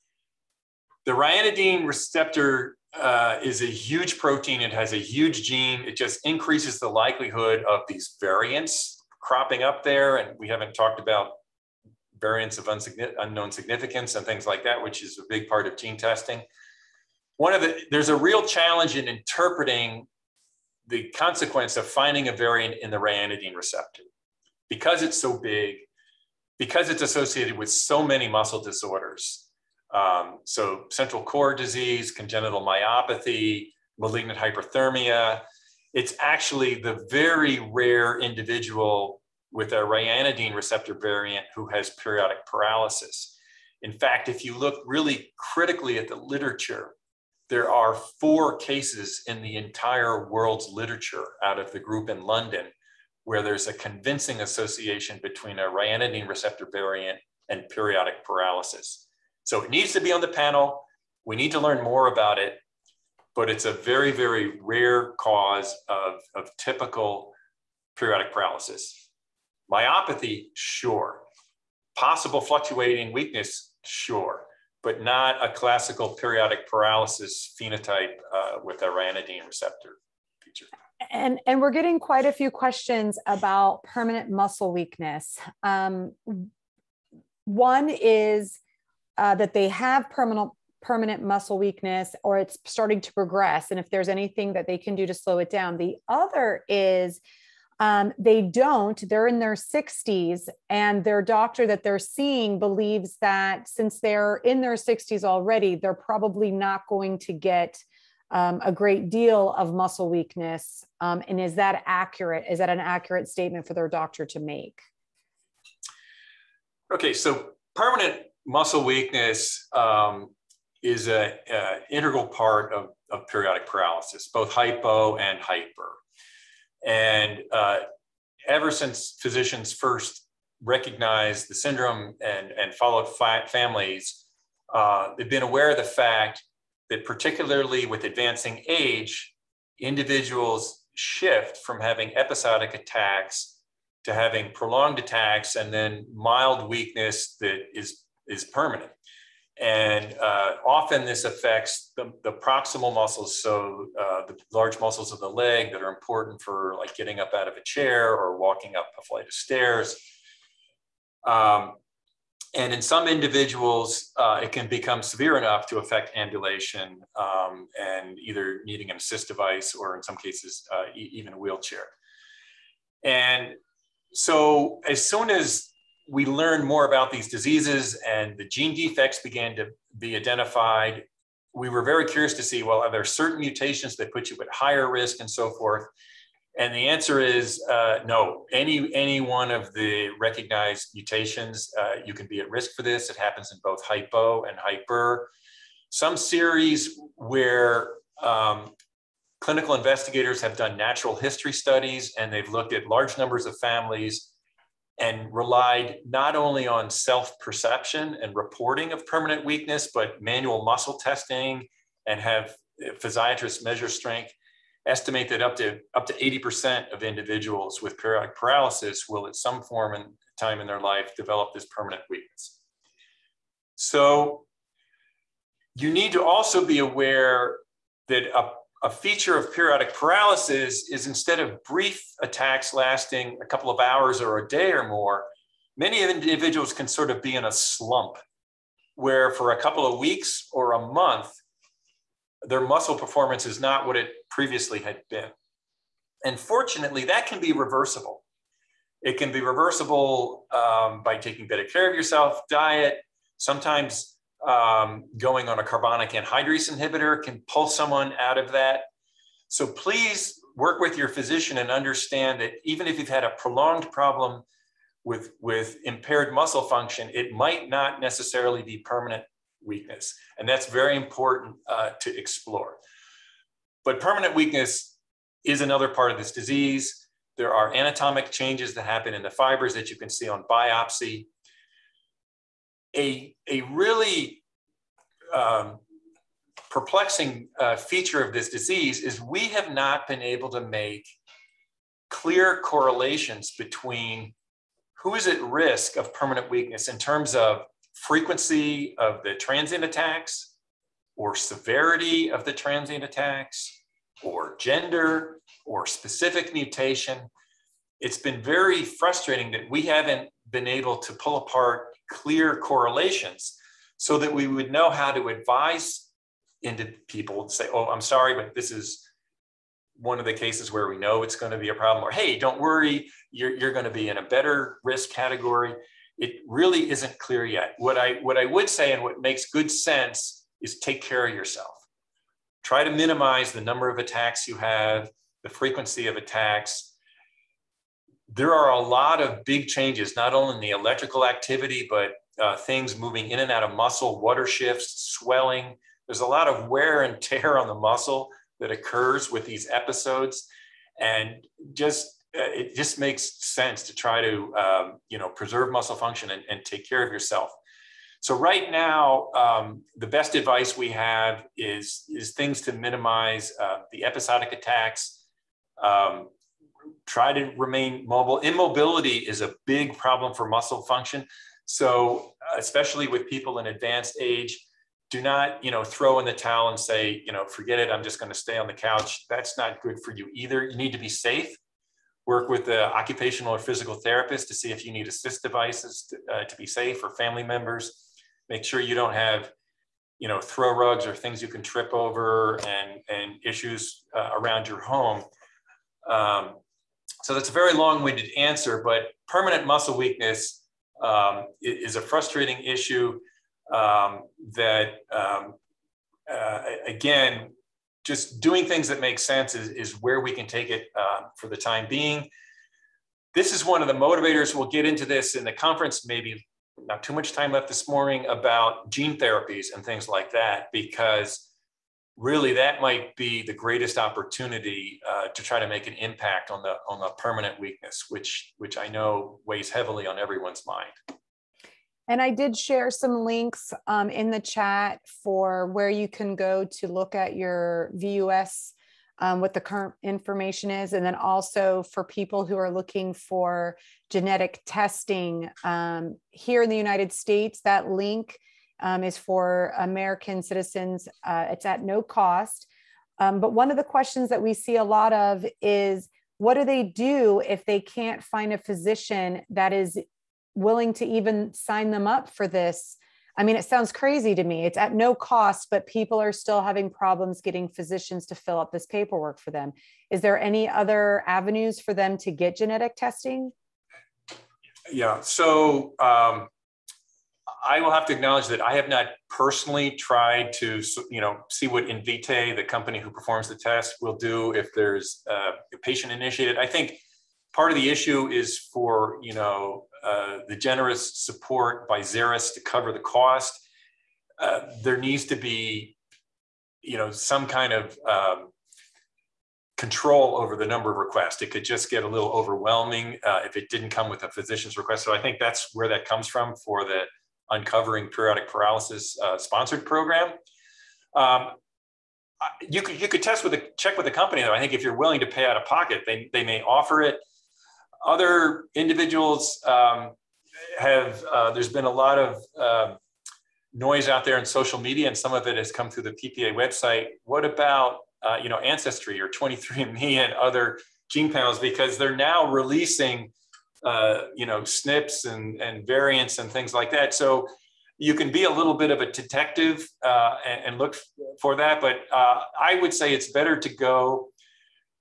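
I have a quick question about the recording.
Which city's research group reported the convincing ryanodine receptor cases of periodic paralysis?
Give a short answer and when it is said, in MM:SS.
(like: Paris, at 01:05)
London, at 00:52.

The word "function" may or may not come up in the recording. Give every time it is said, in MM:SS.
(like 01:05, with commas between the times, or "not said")
04:26, 05:55, 06:10.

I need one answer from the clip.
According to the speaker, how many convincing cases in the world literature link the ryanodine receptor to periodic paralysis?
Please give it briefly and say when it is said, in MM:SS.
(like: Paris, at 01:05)
4, at 00:48.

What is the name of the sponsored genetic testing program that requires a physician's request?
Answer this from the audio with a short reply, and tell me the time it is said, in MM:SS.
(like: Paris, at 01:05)
Uncovering Periodic Paralysis, at 08:27.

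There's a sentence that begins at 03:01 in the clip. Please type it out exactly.
We were very curious to see, well, are there certain mutations that put you at higher risk and so forth?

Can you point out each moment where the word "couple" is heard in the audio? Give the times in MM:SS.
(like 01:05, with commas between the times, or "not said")
03:53, 03:59.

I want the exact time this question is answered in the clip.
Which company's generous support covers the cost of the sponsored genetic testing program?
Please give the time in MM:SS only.
08:11.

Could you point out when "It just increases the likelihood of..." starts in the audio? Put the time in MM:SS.
00:05.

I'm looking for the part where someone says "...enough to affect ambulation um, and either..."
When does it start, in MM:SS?
02:45.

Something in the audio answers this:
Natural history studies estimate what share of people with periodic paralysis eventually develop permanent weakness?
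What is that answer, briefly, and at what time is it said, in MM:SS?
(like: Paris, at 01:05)
up to 80%, at 03:35.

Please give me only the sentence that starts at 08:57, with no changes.
So you can be a little bit of a detective uh, and, and, look for that.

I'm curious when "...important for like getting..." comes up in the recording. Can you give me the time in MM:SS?
02:35.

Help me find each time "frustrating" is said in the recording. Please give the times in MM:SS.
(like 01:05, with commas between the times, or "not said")
05:08, 06:42.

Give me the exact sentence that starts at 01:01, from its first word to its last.
We need to learn more about it, but it's a very, very rare cause of, of typical periodic paralysis.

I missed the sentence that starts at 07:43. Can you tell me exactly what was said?
I mean, it sounds crazy to me.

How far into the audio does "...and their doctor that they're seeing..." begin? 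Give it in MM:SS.
01:40.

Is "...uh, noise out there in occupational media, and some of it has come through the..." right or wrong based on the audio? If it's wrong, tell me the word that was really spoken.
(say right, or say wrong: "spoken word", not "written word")
wrong: "social", not "occupational".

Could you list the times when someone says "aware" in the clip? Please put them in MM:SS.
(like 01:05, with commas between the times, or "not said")
02:15, 03:46.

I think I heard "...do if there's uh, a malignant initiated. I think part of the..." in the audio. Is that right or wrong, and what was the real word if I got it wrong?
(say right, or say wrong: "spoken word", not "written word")
wrong: "patient", not "malignant".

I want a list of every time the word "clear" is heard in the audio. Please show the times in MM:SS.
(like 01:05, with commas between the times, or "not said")
04:52, 05:12, 05:27.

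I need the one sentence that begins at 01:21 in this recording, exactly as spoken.
And, and we're getting quite a few questions about permanent muscle weakness.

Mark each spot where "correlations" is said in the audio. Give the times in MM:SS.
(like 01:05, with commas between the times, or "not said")
04:52, 05:12.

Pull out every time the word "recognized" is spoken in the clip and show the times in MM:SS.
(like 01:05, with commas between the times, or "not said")
02:10, 03:10.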